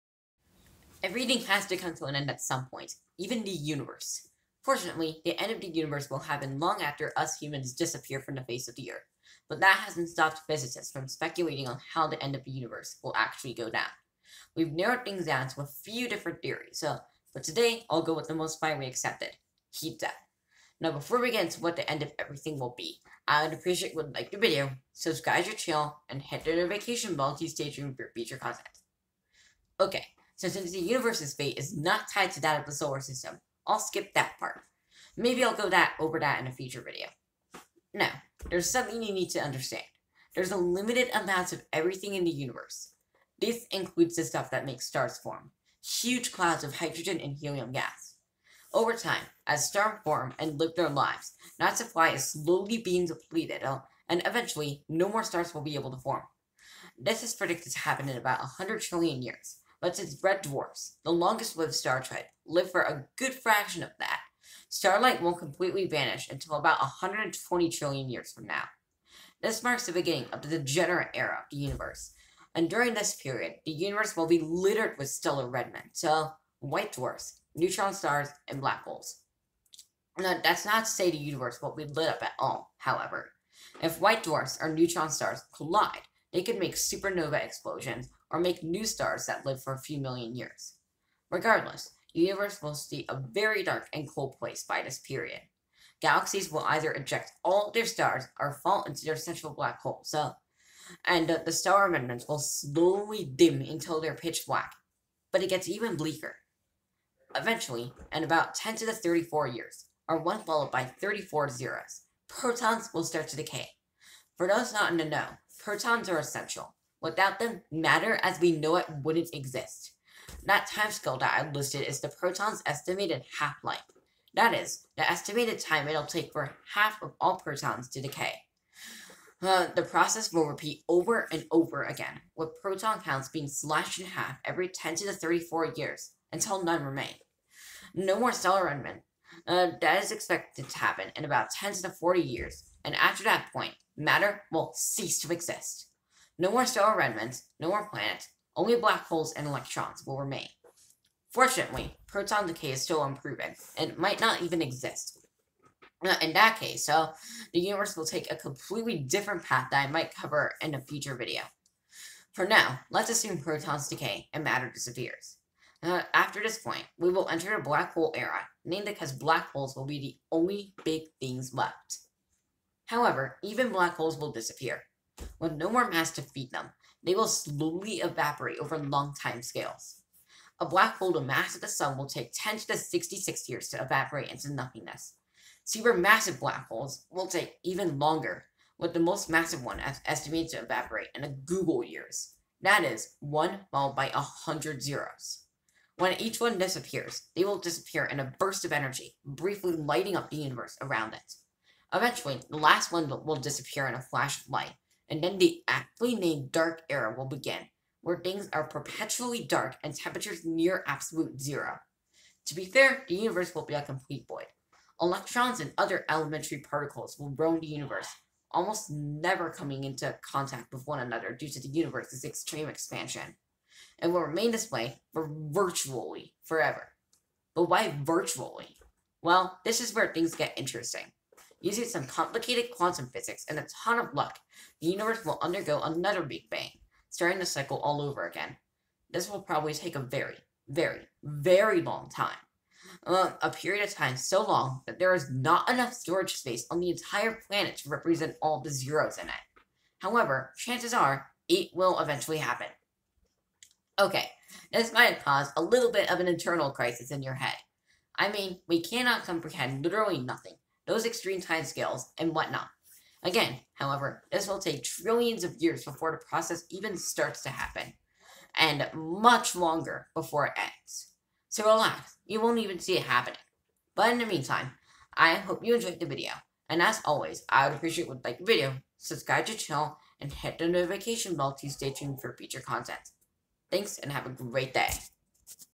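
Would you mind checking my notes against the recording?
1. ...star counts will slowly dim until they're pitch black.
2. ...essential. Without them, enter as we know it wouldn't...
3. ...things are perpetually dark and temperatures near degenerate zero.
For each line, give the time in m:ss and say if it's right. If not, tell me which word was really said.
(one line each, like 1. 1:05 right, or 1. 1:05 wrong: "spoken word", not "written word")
1. 1:41 wrong: "remnants", not "counts"
2. 1:56 wrong: "matter", not "enter"
3. 3:28 wrong: "absolute", not "degenerate".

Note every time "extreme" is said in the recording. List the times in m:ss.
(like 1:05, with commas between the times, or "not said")
3:42, 4:21.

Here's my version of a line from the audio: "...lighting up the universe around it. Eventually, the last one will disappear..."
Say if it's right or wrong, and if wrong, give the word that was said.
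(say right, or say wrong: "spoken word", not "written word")
right.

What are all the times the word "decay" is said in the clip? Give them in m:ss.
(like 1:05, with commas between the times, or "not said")
1:53, 2:08, 2:32, 2:43.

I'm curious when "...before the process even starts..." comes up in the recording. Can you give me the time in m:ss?
4:25.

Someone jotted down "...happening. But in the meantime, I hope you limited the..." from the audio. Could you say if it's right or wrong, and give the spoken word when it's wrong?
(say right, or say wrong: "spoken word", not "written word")
wrong: "enjoyed", not "limited".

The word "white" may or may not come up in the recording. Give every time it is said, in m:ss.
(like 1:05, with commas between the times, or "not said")
1:16, 1:23.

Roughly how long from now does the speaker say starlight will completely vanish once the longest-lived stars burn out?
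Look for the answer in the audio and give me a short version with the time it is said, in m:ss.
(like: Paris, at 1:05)
120 trillion years, at 1:06.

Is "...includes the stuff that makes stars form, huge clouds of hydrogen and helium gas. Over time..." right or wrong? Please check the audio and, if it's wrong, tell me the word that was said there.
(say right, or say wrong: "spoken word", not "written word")
right.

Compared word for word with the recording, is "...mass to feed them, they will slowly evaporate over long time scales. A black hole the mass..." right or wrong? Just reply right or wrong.
right.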